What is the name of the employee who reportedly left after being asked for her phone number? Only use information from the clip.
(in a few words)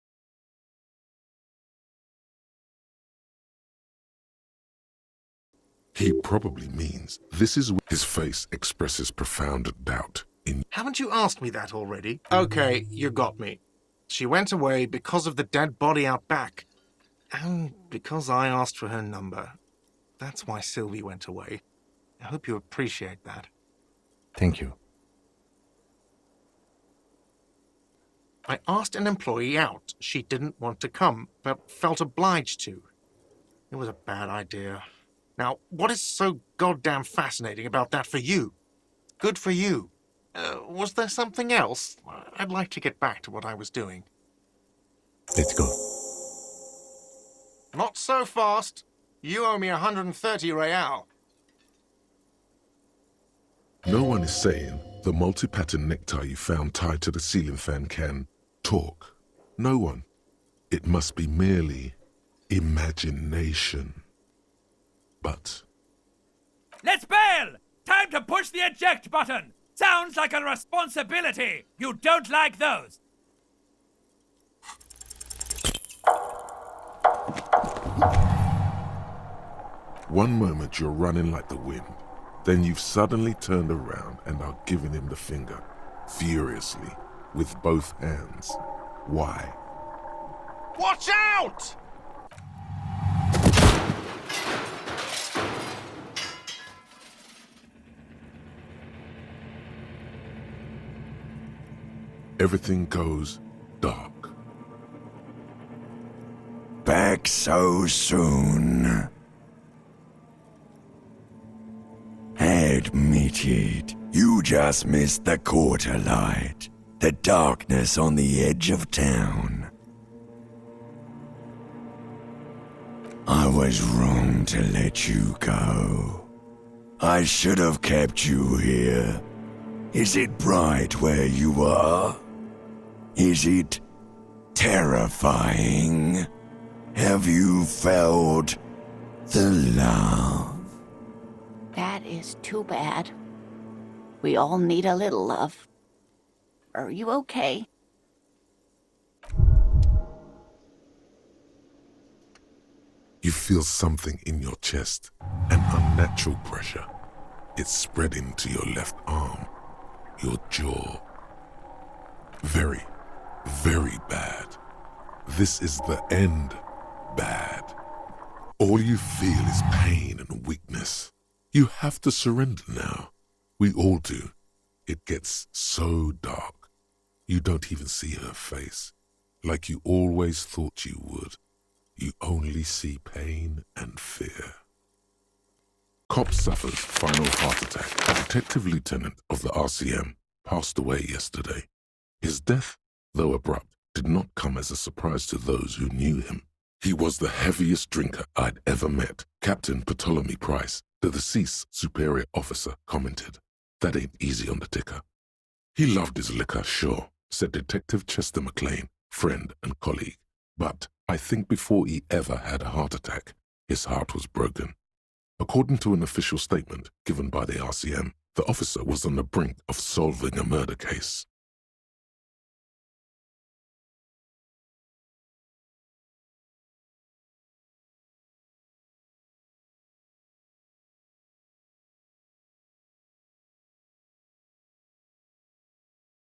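Sylvie.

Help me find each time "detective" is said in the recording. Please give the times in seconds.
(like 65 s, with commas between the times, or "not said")
188 s, 207 s.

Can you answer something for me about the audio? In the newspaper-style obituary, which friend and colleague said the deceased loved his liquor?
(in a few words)
Chester McLaine.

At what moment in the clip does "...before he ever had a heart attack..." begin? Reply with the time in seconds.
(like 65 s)
211 s.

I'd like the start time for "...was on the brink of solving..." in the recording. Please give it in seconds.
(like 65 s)
218 s.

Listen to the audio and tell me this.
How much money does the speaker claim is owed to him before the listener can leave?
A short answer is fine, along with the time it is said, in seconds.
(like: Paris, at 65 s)
130 real, at 49 s.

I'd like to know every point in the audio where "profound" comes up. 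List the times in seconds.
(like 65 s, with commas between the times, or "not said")
9 s.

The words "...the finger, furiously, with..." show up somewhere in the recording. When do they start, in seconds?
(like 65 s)
85 s.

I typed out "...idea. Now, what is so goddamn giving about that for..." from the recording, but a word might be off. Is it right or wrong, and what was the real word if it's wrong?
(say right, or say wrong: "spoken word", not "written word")
wrong: "fascinating", not "giving".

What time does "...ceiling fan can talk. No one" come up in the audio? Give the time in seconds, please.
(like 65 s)
57 s.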